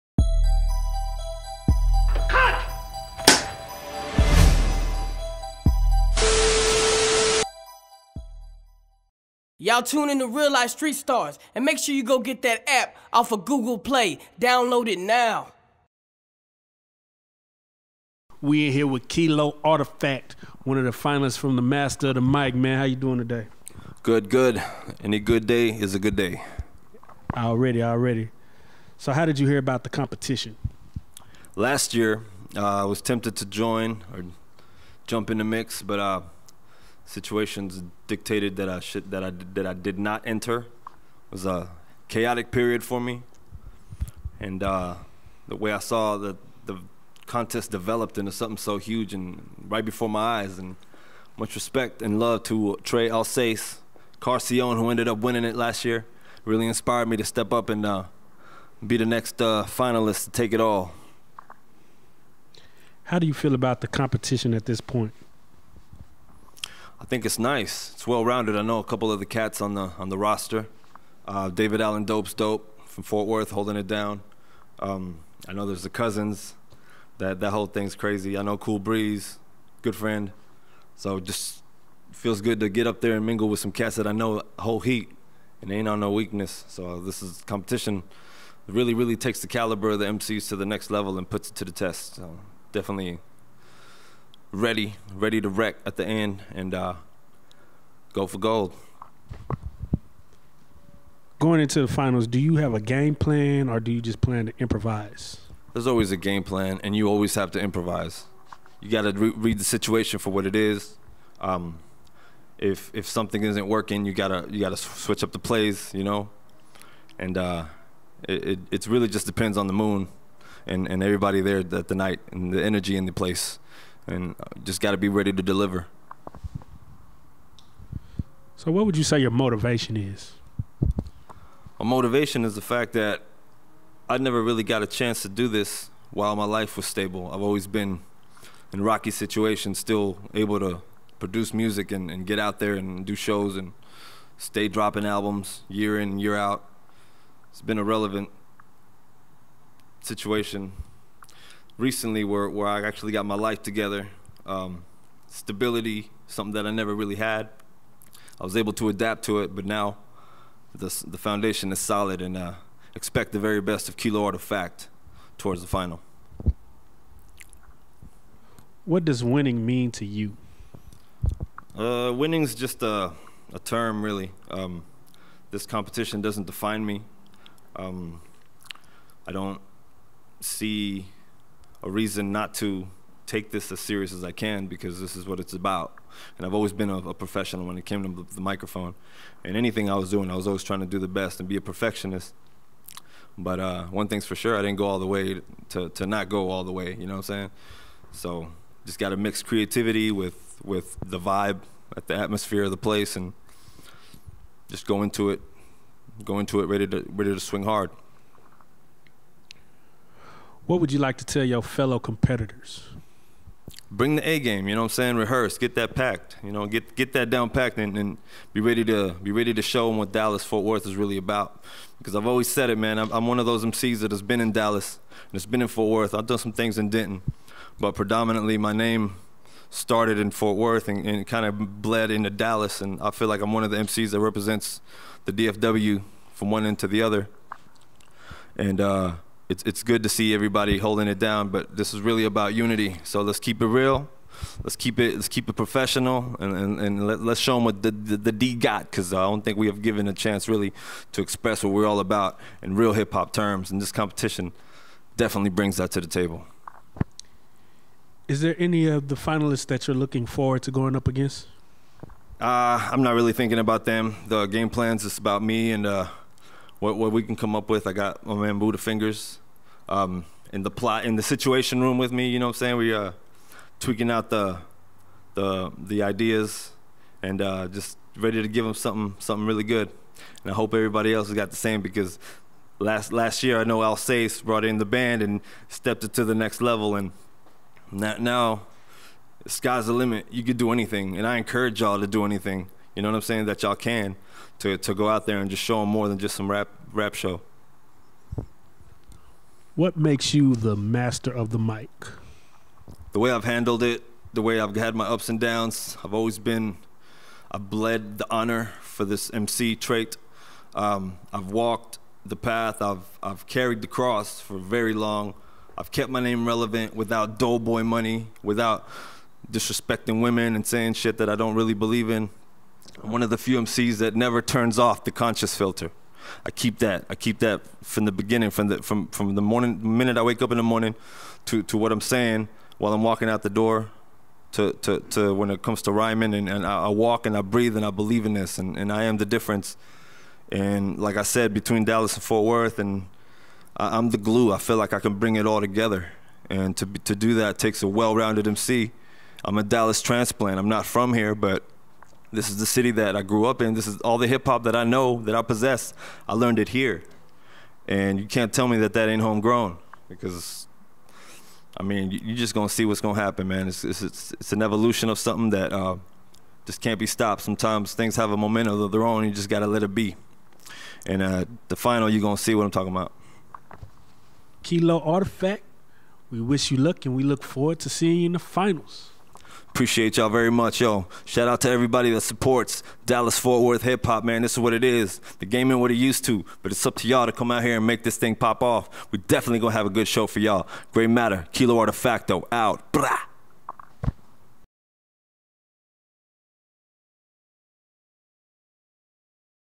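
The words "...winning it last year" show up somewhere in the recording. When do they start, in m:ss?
0:55.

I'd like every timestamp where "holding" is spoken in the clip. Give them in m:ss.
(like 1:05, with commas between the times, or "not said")
1:13, 4:00.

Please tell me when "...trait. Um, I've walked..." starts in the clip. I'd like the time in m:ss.
5:09.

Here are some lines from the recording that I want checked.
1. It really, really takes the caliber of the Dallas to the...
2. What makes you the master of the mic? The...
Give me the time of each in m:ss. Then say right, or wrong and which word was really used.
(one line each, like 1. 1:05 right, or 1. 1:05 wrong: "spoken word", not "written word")
1. 1:28 wrong: "MCs", not "Dallas"
2. 4:59 right.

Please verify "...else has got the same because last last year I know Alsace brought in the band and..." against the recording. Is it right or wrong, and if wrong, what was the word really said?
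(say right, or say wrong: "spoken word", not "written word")
right.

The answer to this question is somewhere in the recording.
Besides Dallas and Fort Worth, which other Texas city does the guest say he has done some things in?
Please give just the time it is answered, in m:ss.
3:46.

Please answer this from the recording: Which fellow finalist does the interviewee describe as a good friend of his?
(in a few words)
Cool Breeze.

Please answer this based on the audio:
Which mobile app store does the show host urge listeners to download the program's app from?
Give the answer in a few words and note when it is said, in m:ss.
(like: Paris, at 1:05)
Google Play, at 0:13.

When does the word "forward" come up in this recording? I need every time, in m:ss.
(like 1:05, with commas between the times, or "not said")
4:20, 6:17.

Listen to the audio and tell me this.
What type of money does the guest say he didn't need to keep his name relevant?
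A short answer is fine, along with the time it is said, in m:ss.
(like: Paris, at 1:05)
doughboy money, at 5:17.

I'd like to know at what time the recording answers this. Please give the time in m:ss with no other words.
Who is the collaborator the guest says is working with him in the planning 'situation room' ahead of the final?
4:28.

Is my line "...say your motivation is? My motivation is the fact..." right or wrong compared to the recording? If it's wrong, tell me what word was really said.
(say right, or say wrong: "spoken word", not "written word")
right.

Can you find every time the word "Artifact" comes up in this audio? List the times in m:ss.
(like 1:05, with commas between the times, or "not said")
0:19, 2:44, 6:15.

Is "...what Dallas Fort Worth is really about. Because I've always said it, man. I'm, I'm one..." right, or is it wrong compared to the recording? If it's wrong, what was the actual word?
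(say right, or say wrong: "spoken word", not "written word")
right.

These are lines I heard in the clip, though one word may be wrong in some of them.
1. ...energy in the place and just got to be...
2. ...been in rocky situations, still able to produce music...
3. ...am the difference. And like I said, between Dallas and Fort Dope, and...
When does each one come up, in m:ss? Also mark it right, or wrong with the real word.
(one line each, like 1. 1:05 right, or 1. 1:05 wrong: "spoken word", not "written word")
1. 2:02 right
2. 2:17 right
3. 5:39 wrong: "Worth", not "Dope".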